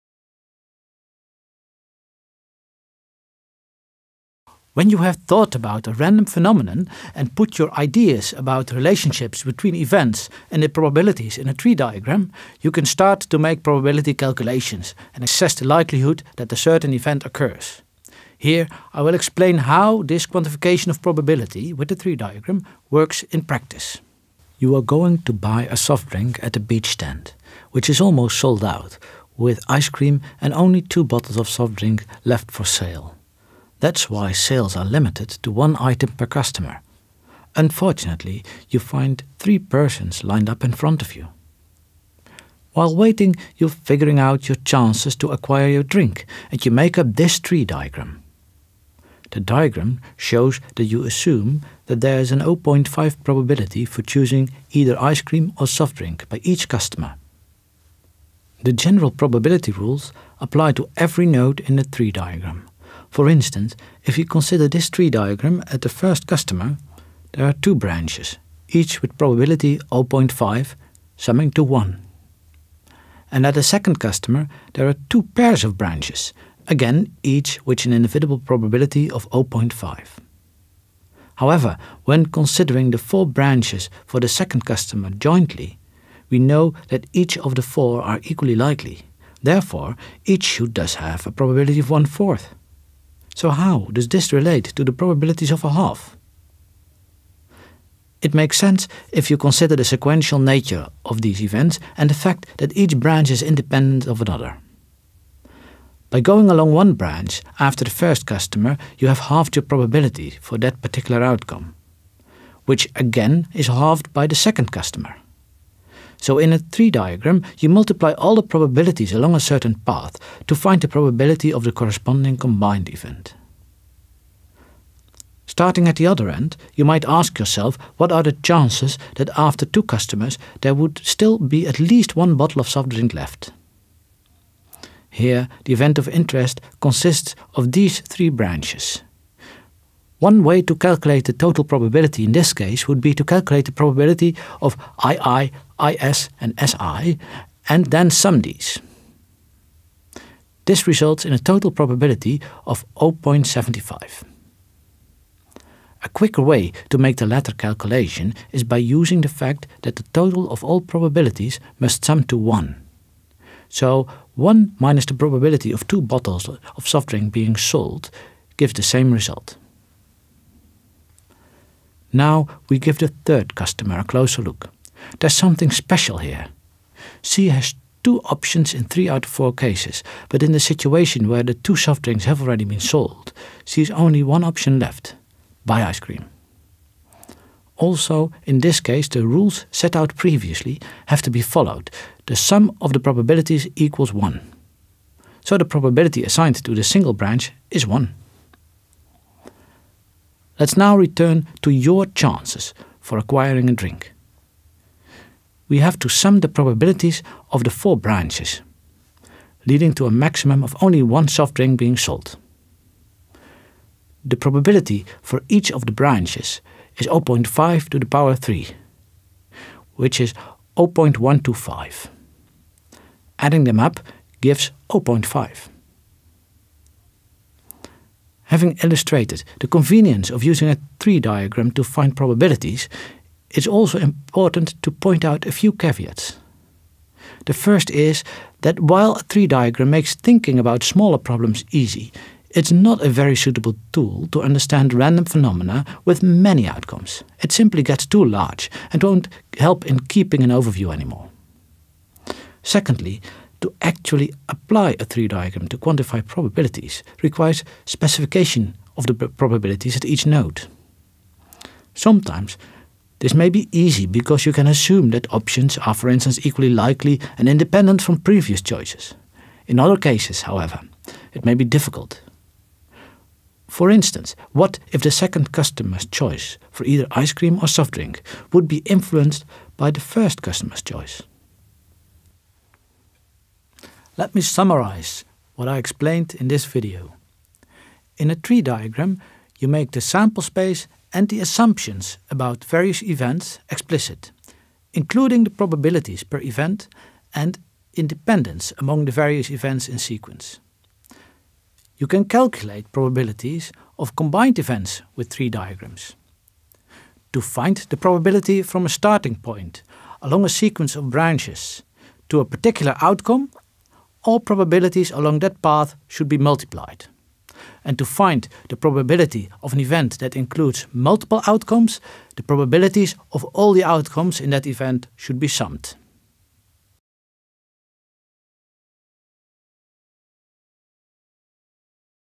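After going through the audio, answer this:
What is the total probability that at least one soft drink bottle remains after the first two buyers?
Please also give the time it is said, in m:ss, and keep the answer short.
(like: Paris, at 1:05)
0.75, at 2:32.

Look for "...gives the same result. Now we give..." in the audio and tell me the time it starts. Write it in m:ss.
2:48.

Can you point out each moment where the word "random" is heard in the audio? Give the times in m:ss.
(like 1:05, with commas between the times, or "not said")
0:05, 4:04.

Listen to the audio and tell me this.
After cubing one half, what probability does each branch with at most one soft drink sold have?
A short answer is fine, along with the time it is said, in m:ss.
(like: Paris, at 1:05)
0.125, at 3:40.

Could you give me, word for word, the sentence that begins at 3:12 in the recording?
The sum of the probabilities equals 1.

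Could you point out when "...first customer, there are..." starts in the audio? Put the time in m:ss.
1:05.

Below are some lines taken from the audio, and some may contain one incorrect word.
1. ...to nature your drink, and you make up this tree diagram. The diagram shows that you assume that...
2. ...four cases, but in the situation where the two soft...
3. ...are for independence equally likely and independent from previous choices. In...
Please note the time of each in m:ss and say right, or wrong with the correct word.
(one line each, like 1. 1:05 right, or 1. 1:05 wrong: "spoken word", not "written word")
1. 0:45 wrong: "acquire", not "nature"
2. 2:59 right
3. 4:25 wrong: "instance", not "independence".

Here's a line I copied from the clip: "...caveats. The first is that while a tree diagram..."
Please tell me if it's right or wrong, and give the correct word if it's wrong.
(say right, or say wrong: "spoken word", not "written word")
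right.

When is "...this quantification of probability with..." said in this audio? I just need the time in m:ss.
0:20.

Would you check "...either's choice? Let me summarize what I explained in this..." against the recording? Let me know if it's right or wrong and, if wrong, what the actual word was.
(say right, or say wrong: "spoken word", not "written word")
wrong: "customer", not "either".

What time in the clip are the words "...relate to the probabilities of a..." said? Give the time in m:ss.
1:34.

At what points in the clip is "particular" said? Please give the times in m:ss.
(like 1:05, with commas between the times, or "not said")
1:50, 5:12.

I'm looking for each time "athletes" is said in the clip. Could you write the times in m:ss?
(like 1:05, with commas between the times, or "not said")
not said.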